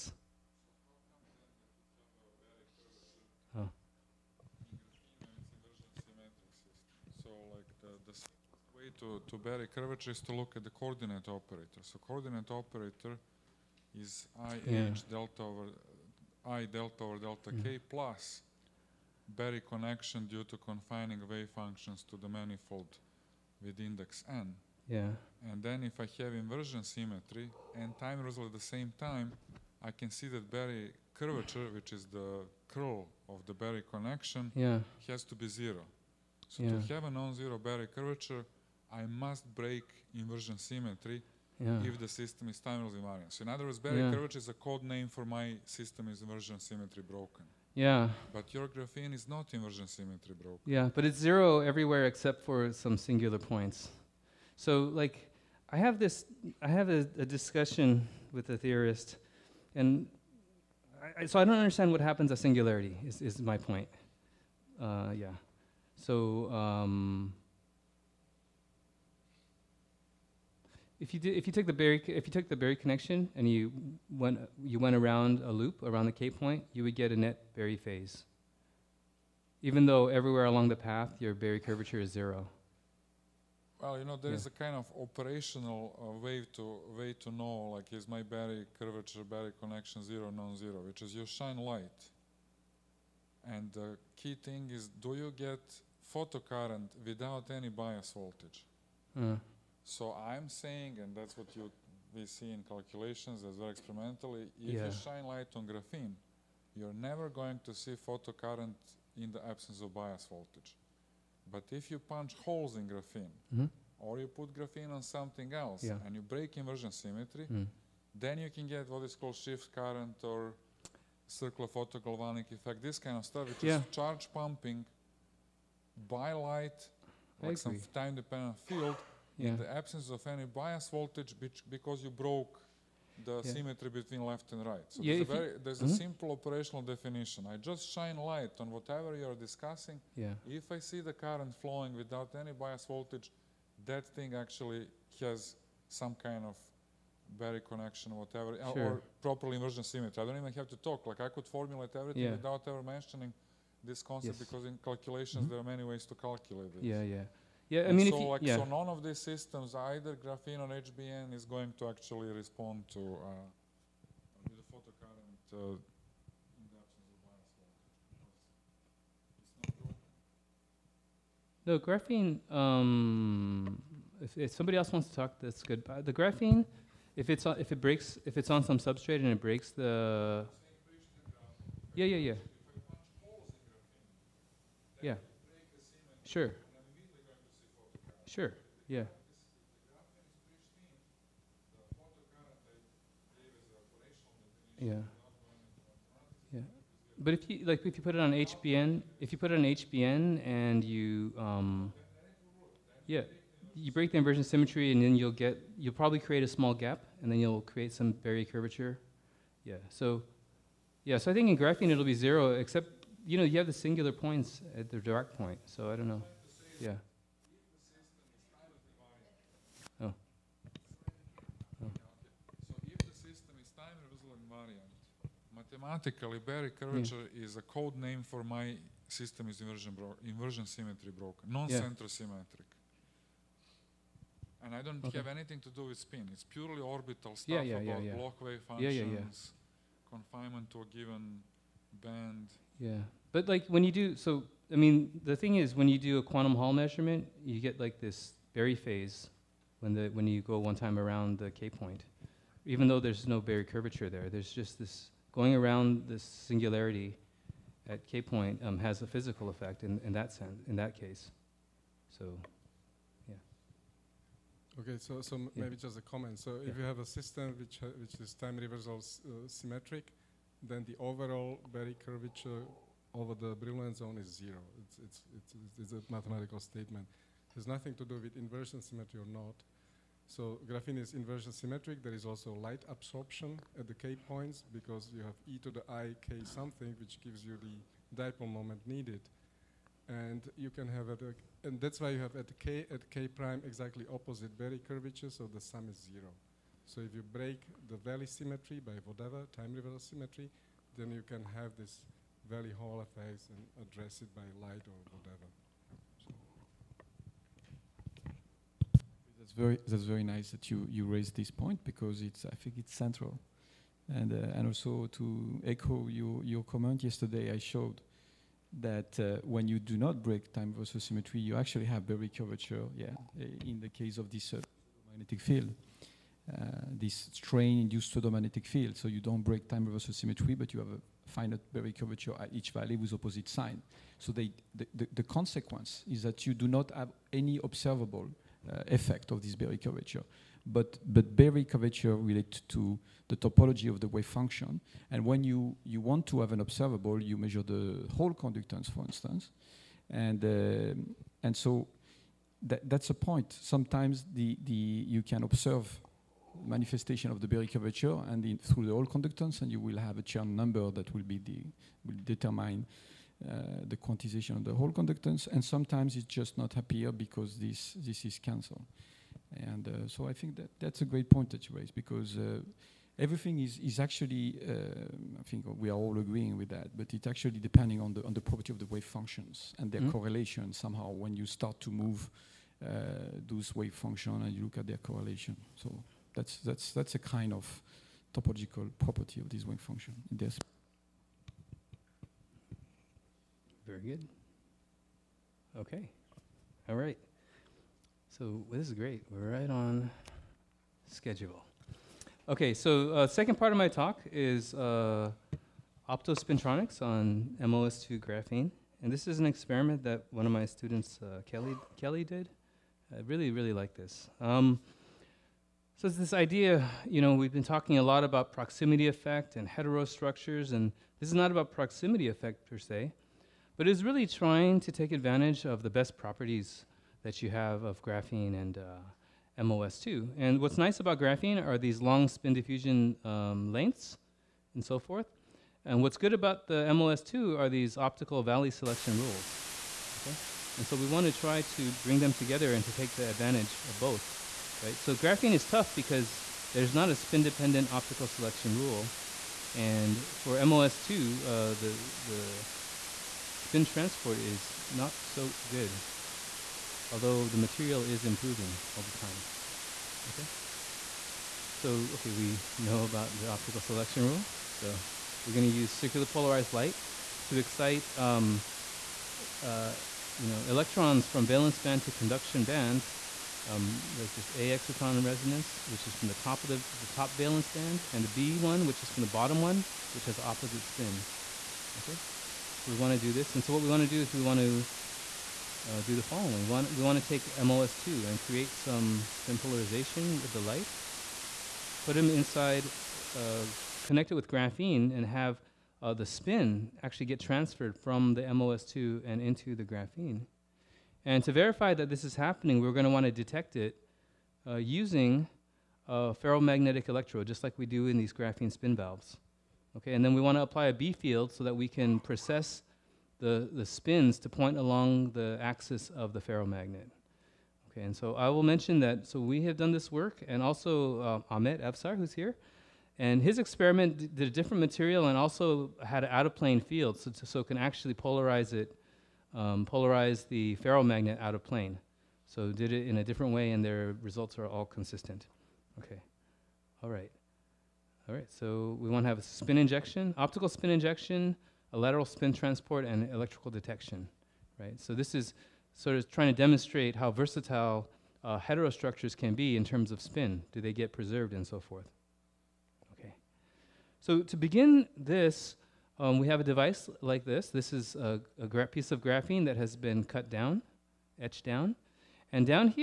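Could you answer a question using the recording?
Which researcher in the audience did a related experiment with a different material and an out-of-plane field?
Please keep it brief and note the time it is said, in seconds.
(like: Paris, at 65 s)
Ahmet Avsar, at 521 s.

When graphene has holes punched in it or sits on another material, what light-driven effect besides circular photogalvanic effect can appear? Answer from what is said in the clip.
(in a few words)
shift current.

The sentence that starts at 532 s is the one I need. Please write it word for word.
So did it in a different way, and their results are all consistent.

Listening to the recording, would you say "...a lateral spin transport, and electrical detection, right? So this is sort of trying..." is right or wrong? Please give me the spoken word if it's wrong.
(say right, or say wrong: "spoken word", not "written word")
right.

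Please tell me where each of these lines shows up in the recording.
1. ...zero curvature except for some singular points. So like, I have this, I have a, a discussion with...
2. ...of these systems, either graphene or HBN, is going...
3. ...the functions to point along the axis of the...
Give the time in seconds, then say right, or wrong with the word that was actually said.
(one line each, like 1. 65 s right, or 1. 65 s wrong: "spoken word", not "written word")
1. 51 s wrong: "everywhere", not "curvature"
2. 158 s right
3. 513 s wrong: "spins", not "functions".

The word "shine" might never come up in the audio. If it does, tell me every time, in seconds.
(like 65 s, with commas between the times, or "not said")
91 s, 104 s, 137 s.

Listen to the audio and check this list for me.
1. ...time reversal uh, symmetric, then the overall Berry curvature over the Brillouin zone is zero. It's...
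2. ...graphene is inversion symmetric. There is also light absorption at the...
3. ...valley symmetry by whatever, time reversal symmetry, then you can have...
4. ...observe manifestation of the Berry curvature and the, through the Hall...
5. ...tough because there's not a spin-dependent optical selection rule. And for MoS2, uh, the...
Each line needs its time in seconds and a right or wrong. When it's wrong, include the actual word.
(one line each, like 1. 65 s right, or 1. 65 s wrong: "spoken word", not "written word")
1. 268 s right
2. 280 s right
3. 297 s right
4. 355 s right
5. 445 s right.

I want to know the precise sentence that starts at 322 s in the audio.
Yeah, eh, in the case of this uh, magnetic field.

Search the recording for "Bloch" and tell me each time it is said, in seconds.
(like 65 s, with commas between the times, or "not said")
238 s.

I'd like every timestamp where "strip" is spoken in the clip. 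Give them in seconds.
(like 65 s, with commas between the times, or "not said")
not said.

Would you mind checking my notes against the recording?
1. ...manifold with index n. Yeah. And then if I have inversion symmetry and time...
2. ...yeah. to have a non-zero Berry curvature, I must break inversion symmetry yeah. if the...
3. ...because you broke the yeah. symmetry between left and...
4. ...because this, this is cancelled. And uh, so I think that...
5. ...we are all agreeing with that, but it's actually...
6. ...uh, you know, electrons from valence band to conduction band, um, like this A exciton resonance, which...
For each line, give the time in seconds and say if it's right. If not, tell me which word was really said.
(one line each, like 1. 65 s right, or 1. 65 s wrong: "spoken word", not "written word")
1. 22 s right
2. 36 s right
3. 131 s right
4. 367 s right
5. 375 s right
6. 469 s right.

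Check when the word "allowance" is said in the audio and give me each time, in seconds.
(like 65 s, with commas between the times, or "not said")
not said.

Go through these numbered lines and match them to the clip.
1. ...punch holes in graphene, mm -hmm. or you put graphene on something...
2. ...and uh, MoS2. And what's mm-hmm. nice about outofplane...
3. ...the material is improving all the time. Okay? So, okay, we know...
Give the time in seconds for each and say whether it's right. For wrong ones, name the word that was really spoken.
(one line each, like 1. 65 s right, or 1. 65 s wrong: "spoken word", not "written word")
1. 111 s right
2. 428 s wrong: "graphene", not "outofplane"
3. 457 s right.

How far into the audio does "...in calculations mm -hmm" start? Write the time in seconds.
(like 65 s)
154 s.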